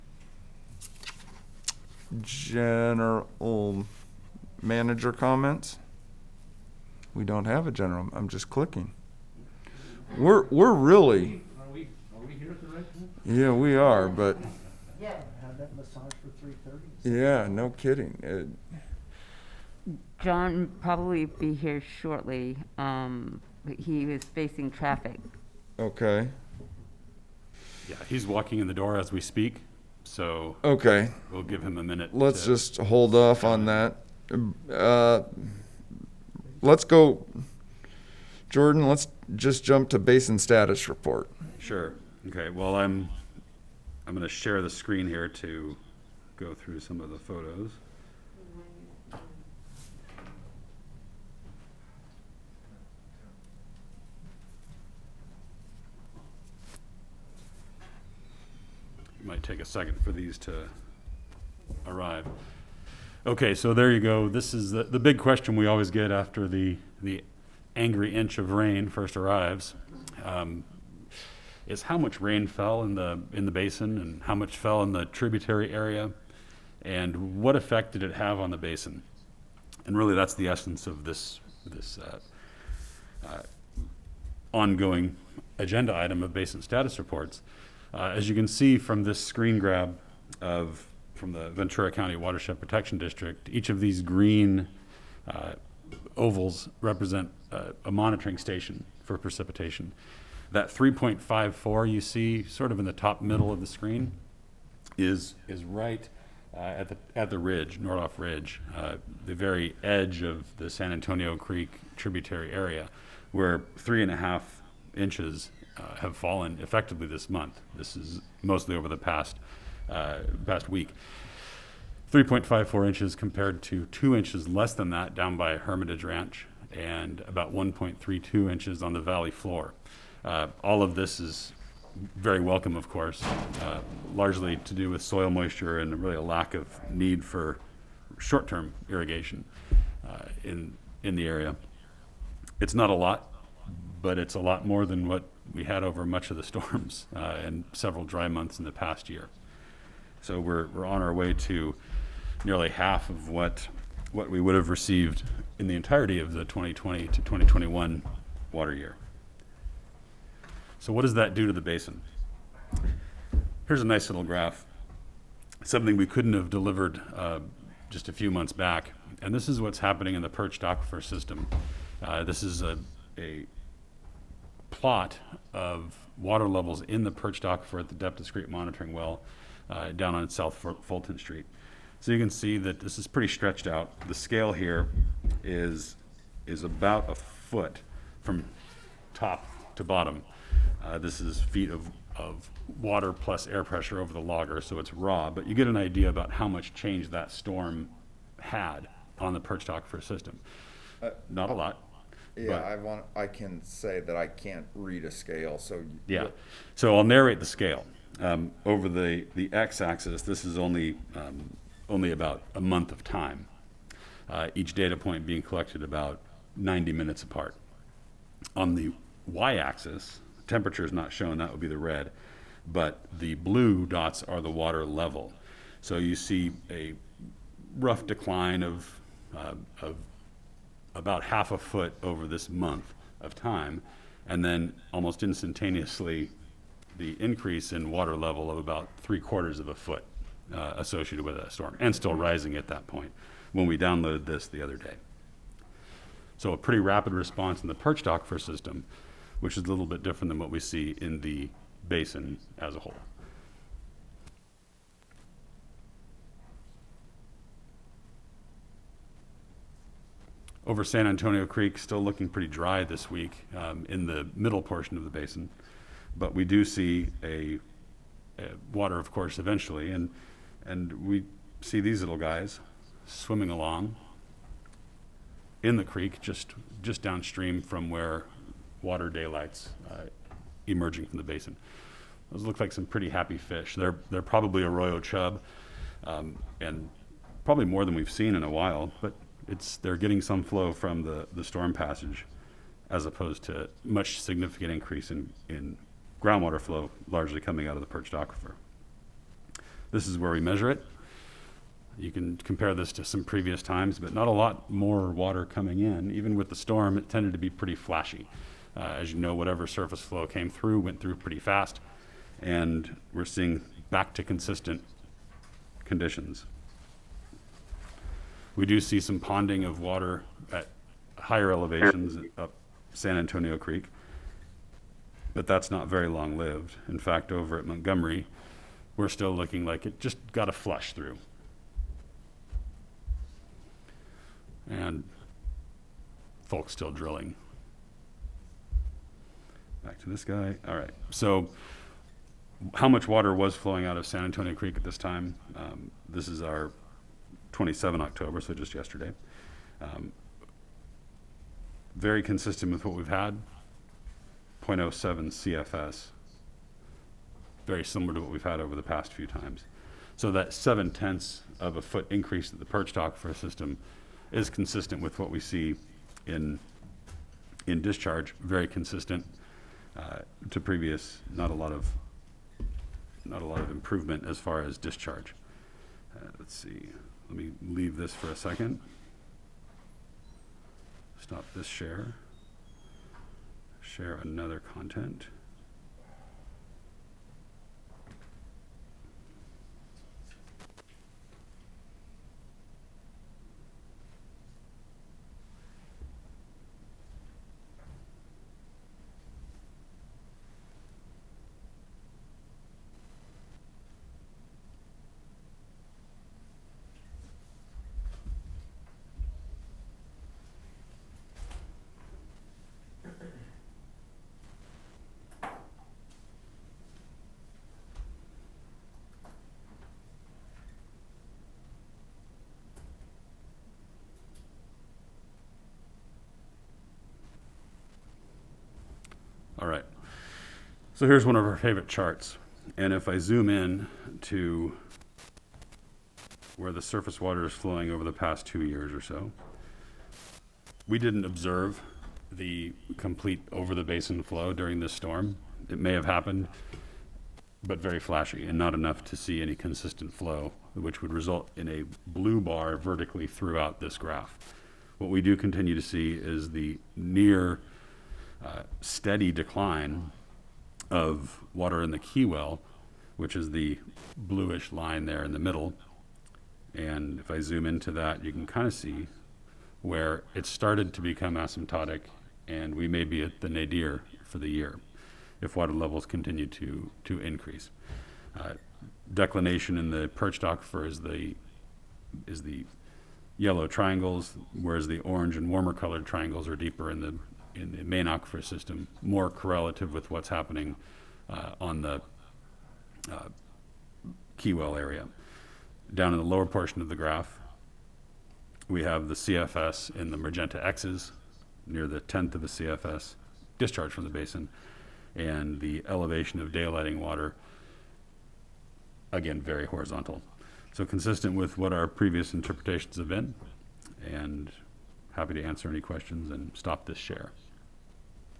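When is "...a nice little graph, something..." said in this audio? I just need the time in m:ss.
2:43.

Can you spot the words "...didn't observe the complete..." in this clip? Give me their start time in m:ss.
7:20.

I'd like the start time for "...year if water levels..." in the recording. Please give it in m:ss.
7:54.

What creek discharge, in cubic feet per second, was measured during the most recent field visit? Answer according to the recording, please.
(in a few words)
0.07 CFS.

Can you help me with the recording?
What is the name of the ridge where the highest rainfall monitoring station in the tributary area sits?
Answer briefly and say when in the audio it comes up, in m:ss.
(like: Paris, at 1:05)
Nordhoff Ridge, at 1:47.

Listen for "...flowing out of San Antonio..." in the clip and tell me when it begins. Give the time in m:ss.
5:43.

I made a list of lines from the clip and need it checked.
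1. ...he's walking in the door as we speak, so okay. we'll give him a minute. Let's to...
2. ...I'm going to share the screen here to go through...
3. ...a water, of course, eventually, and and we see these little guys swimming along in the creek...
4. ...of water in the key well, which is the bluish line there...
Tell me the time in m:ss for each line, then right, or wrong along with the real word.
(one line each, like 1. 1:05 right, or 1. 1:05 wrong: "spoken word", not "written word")
1. 0:28 right
2. 0:44 right
3. 4:28 right
4. 7:40 right.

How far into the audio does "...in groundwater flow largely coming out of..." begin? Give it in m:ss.
4:55.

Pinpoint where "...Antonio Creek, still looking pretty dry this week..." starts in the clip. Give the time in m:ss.
4:21.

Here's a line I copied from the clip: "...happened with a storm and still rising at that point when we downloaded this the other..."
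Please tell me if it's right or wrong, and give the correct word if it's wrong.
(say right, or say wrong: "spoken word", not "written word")
wrong: "associated", not "happened".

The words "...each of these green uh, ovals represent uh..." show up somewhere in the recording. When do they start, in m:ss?
1:33.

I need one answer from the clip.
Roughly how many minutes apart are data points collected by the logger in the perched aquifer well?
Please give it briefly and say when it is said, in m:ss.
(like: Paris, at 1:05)
90 minutes, at 3:36.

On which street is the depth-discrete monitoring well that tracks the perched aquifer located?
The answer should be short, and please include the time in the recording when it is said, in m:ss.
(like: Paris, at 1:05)
South Fulton Street, at 3:00.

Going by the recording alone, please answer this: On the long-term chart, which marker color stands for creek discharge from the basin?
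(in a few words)
magenta.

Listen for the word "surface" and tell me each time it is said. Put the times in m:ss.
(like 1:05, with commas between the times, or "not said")
5:09, 7:16.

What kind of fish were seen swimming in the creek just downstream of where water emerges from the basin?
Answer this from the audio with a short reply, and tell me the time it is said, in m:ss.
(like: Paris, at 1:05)
arroyo chub, at 4:44.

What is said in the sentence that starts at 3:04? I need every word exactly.
The scale here is, is about a foot from top to bottom.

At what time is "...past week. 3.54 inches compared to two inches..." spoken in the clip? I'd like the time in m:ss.
2:00.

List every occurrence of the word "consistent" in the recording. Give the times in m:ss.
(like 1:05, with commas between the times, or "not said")
5:14, 5:52, 6:04, 6:08, 7:29, 8:30.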